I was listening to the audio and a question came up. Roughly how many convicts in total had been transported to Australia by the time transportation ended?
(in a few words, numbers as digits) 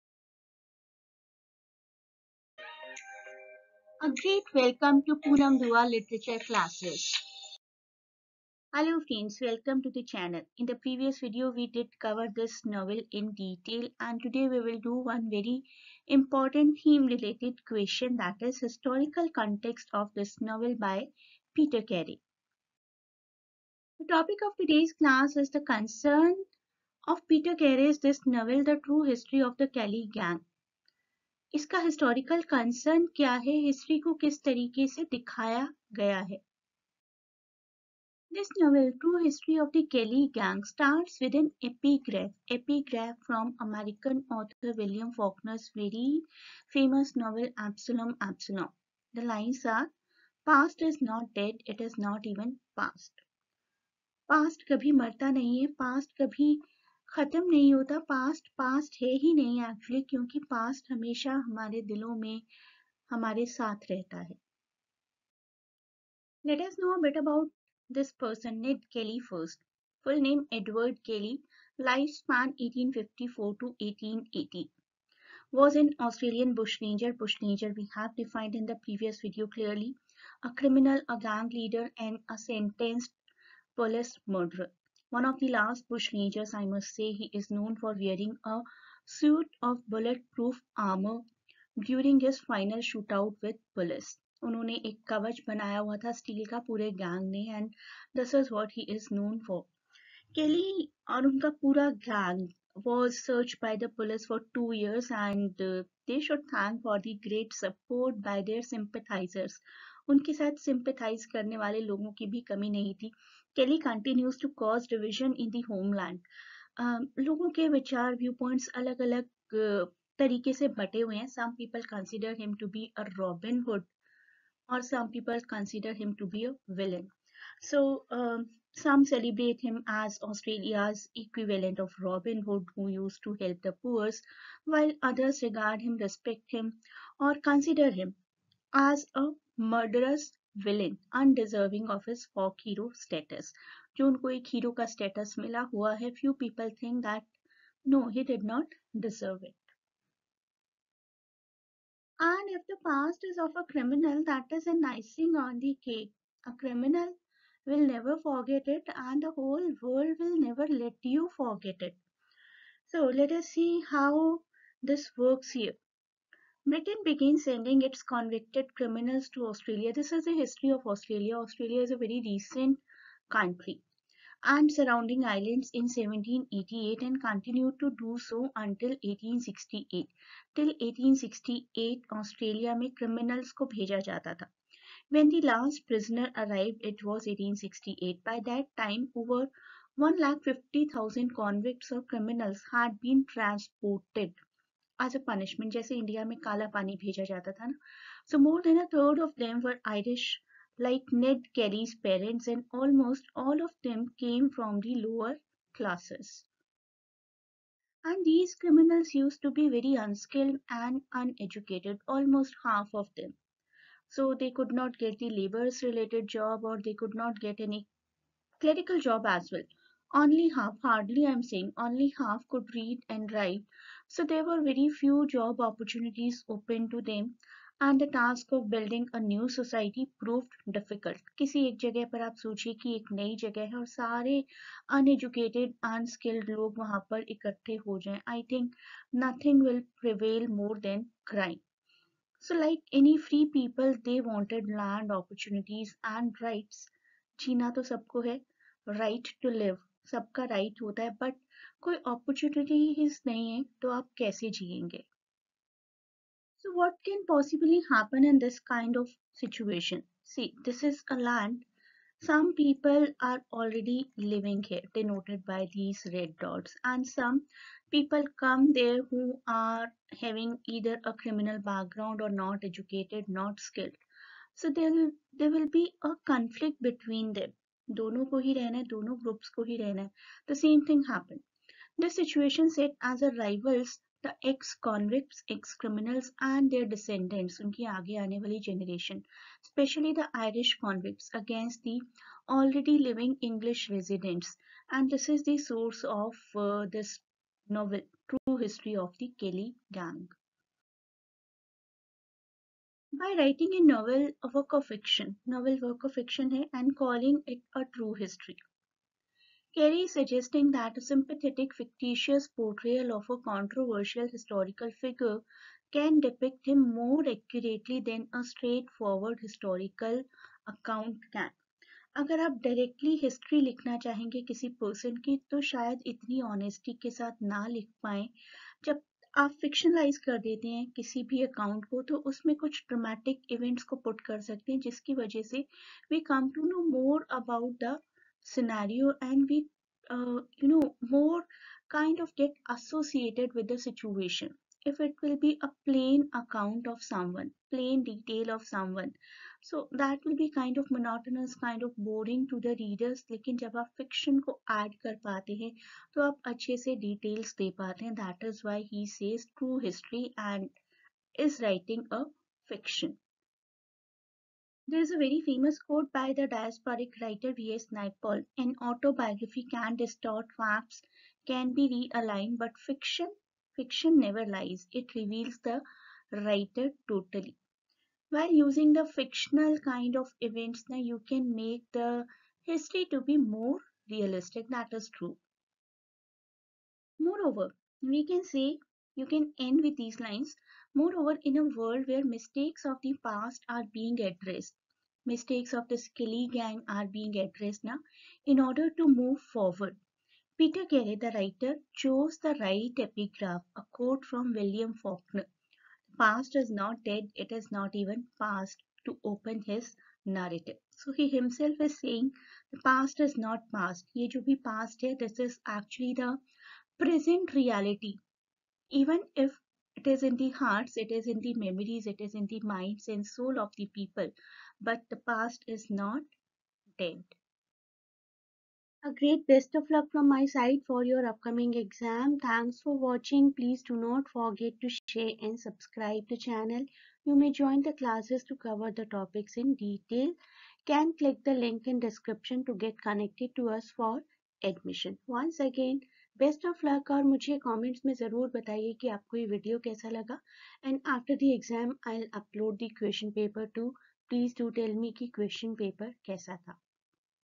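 150,000.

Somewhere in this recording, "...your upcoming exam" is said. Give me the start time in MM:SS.
07:11.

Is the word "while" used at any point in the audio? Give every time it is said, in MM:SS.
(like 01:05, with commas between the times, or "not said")
02:14, 06:18.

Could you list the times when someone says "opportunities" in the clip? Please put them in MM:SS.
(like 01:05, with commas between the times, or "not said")
03:45, 04:05.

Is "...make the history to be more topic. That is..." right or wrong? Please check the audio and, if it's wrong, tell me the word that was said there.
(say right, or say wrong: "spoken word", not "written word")
wrong: "realistic", not "topic".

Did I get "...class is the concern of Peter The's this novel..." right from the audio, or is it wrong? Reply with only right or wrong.
wrong.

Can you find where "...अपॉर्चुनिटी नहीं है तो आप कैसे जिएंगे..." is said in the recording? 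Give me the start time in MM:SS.
04:12.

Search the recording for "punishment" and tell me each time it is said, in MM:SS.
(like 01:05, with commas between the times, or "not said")
03:15.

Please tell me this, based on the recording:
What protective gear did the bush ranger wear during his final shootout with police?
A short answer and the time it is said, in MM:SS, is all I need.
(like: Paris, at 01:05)
bulletproof armor, at 01:29.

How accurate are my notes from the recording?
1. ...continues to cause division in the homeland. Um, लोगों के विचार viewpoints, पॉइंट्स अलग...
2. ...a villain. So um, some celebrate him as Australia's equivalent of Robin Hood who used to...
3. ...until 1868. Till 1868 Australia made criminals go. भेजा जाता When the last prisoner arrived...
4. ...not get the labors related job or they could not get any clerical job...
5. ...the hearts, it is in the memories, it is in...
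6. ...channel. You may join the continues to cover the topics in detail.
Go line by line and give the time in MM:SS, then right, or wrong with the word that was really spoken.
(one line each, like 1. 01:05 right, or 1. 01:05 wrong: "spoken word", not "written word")
1. 01:53 right
2. 02:06 right
3. 02:58 right
4. 03:34 right
5. 07:00 right
6. 07:16 wrong: "classes", not "continues".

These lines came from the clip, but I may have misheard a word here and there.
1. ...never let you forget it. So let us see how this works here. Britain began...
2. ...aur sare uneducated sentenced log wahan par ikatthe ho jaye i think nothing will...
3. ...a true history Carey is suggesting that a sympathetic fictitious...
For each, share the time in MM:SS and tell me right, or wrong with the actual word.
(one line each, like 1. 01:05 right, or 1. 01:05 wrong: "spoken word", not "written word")
1. 02:40 right
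2. 03:53 wrong: "unskilled", not "sentenced"
3. 05:07 right.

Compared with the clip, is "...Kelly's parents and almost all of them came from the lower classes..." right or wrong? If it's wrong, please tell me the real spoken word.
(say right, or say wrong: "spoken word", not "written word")
right.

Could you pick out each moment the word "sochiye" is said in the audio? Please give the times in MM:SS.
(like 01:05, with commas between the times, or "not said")
03:52.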